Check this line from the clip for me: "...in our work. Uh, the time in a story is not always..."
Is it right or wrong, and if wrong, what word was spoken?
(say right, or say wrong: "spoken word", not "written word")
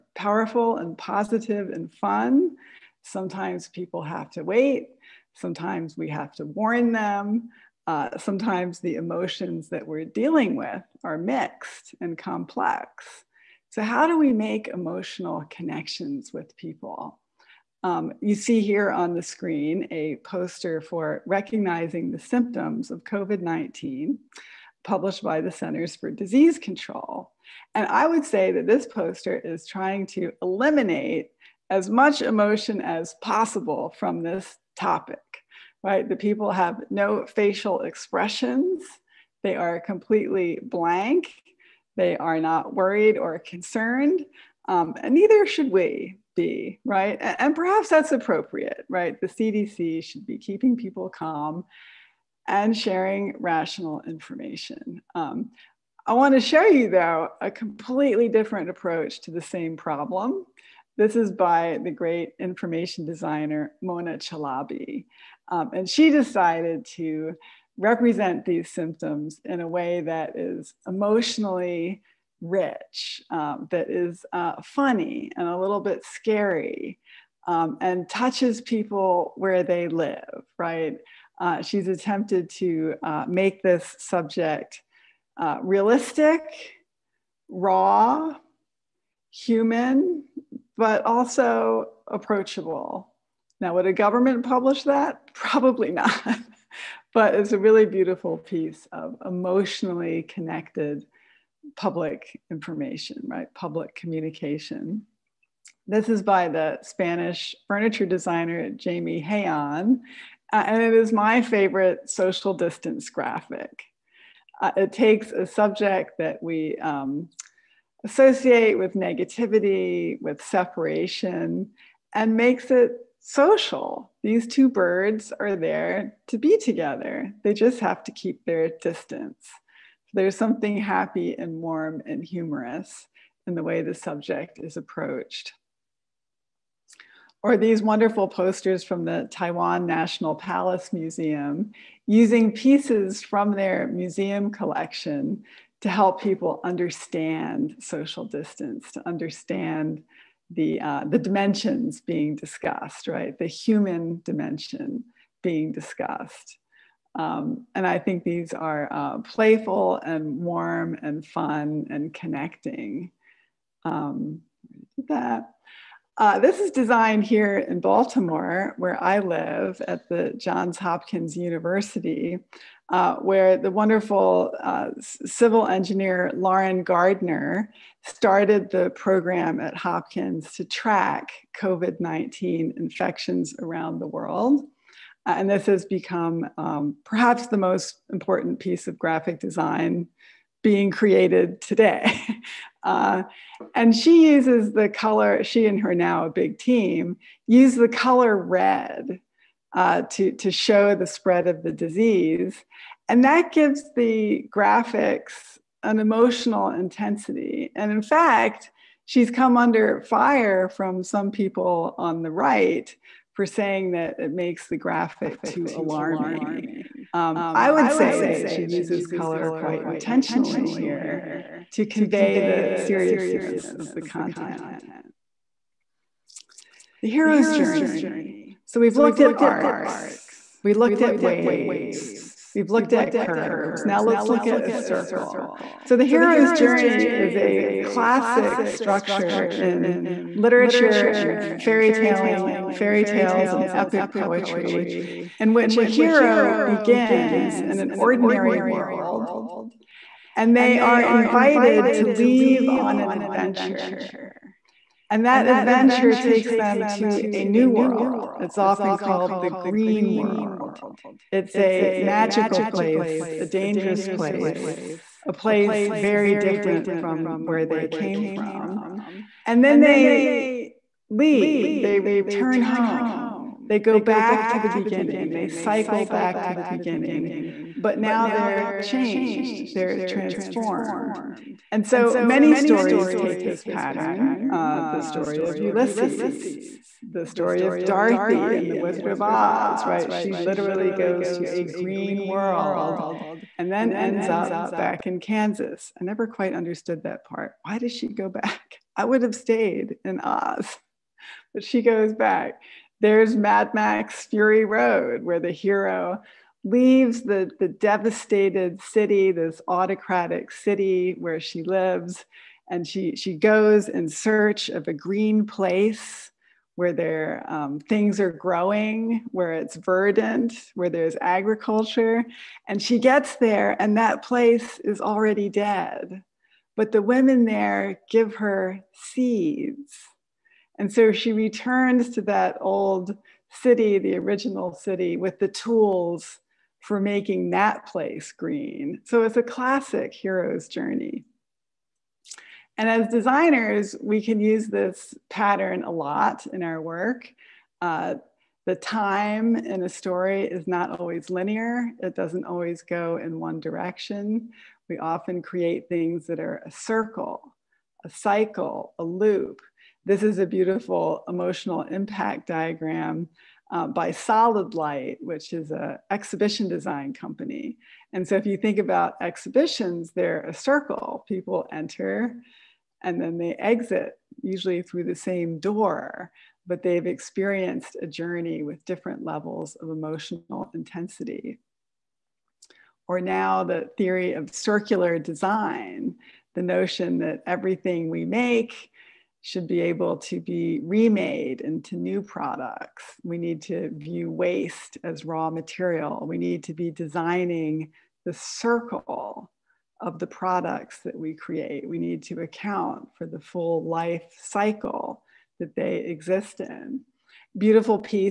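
right.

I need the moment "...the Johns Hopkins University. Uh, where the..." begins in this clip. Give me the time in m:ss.
2:50.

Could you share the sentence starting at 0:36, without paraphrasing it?
The people have no facial expressions.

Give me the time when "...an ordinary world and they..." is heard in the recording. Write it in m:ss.
4:07.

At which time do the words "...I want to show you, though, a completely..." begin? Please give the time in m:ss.
0:56.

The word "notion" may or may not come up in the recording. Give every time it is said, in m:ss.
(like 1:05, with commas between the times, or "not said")
6:26.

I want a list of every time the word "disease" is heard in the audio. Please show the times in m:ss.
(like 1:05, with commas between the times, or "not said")
0:26, 3:21.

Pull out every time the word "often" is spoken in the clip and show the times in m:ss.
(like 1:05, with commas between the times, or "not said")
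4:18, 5:54.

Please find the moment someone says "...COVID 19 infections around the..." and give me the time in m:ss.
3:01.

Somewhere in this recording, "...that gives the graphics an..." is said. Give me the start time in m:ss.
3:23.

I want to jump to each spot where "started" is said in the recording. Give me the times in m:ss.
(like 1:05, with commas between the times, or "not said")
2:58.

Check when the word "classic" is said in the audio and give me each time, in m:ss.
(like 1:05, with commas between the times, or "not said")
3:57, 5:39.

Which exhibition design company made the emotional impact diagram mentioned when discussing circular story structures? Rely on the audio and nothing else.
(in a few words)
Solid Light.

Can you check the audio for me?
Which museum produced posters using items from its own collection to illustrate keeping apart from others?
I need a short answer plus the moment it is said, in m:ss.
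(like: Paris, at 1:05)
Taiwan National Palace Museum, at 2:19.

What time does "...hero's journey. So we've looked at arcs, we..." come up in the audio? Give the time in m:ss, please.
3:47.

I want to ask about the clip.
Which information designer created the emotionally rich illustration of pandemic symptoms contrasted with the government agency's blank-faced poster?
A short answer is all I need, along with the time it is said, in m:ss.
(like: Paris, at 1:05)
Mona Chalabi, at 1:03.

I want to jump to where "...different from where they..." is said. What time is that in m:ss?
4:26.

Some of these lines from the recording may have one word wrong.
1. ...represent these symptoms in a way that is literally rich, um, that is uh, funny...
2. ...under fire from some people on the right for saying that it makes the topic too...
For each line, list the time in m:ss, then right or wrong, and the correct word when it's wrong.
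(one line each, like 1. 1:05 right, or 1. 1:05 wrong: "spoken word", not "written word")
1. 1:07 wrong: "emotionally", not "literally"
2. 3:29 wrong: "graphic", not "topic".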